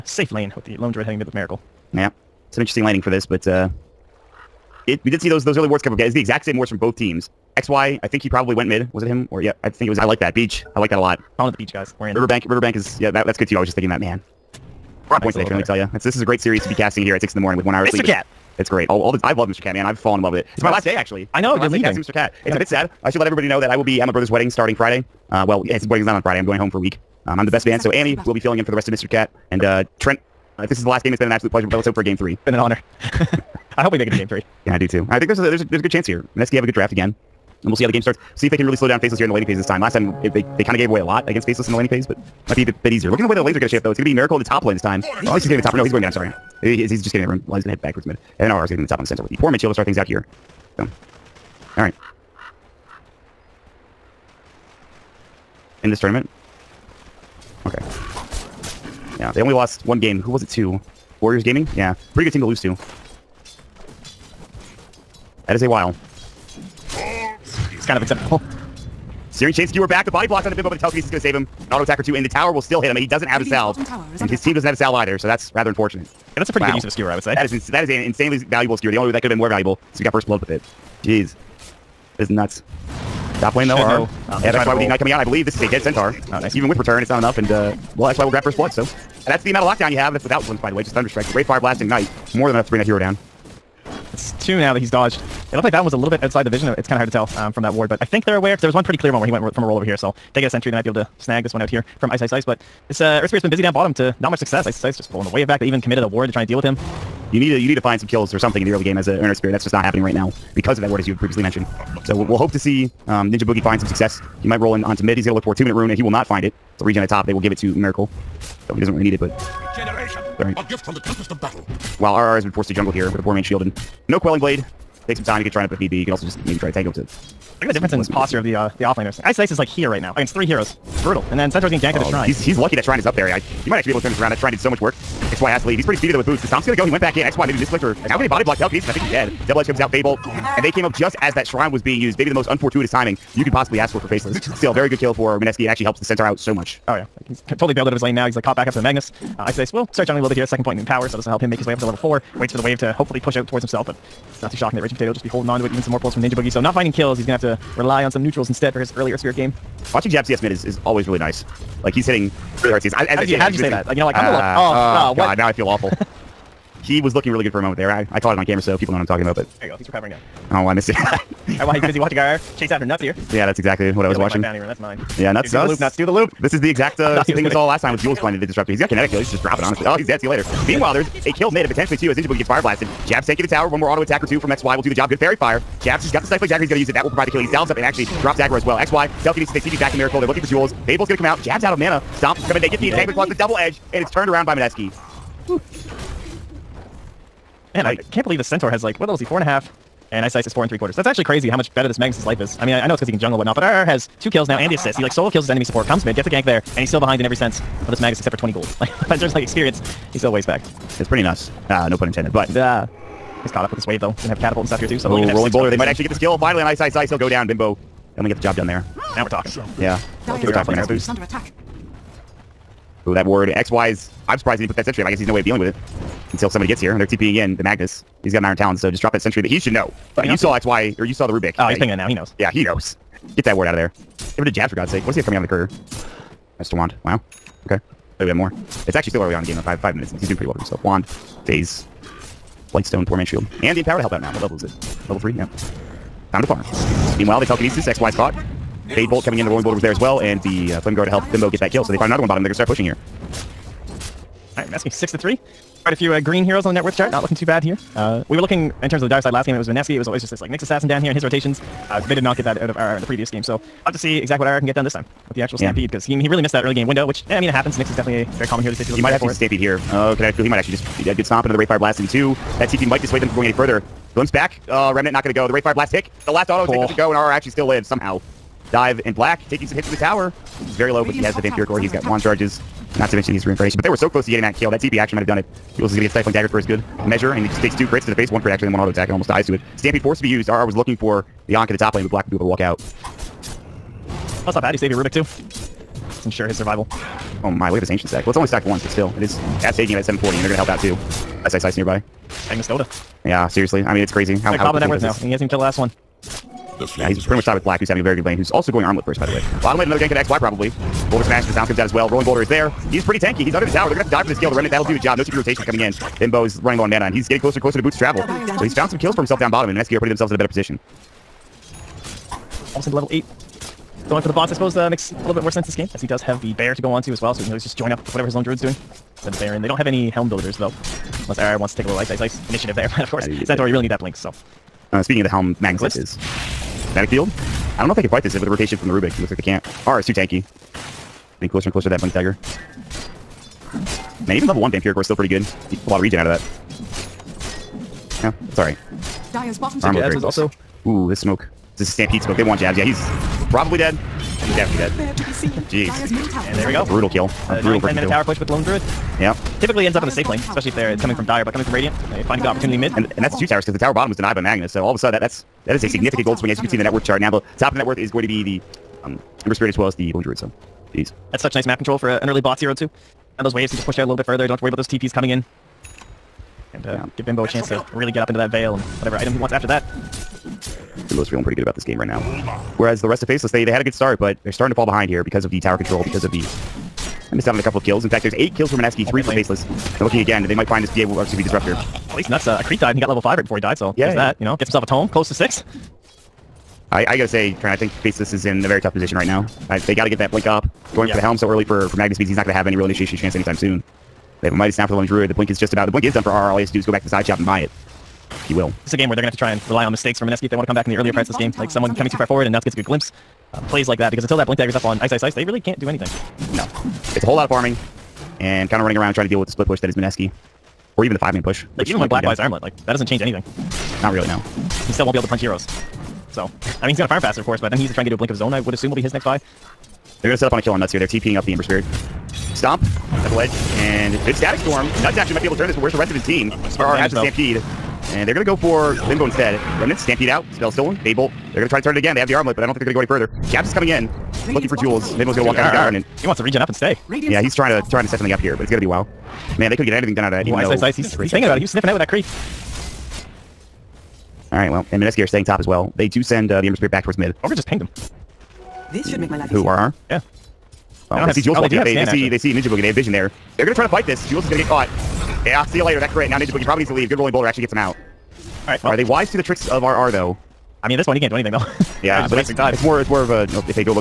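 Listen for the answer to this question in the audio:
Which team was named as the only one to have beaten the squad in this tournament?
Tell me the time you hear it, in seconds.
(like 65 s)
61 s.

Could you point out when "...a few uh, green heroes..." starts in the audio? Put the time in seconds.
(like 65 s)
255 s.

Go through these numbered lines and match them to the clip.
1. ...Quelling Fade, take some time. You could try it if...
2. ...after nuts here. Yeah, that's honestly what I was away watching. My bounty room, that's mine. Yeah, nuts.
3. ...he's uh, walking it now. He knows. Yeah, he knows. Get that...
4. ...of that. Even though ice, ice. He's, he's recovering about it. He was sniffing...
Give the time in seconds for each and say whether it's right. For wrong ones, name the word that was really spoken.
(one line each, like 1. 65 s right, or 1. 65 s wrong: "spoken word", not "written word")
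1. 124 s wrong: "Blade", not "Fade"
2. 172 s wrong: "exactly", not "honestly"
3. 231 s wrong: "pinging", not "walking"
4. 450 s wrong: "thinking", not "recovering".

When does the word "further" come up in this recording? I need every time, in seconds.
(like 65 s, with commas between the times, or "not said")
273 s, 374 s, 443 s.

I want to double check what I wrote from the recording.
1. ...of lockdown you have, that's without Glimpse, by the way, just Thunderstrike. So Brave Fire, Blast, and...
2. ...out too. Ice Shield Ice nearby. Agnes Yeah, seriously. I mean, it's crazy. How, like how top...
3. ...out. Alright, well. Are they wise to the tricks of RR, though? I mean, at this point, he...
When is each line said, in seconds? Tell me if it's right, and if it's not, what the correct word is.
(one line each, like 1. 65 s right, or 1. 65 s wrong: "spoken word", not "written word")
1. 89 s right
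2. 300 s wrong: "Ice", not "Shield"
3. 467 s right.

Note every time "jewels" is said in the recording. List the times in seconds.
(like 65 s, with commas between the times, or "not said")
190 s, 444 s.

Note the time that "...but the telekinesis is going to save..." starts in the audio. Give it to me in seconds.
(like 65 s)
70 s.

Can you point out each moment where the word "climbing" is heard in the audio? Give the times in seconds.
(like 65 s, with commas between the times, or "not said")
not said.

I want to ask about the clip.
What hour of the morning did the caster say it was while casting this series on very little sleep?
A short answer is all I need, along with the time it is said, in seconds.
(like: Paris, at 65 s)
6, at 17 s.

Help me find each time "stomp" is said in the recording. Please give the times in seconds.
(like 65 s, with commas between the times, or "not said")
136 s, 192 s, 271 s, 432 s.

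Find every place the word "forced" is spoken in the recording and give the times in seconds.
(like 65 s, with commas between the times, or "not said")
122 s, 290 s.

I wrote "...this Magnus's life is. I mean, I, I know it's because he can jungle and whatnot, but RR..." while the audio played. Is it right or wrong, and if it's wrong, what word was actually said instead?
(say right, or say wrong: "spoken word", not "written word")
right.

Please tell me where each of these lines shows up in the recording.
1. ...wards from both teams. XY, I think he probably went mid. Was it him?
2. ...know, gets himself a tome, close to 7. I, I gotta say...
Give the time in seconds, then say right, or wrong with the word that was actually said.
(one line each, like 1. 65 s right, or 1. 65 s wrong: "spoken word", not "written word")
1. 6 s right
2. 394 s wrong: "6", not "7".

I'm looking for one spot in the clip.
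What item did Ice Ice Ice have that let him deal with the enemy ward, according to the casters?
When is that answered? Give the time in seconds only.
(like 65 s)
228 s.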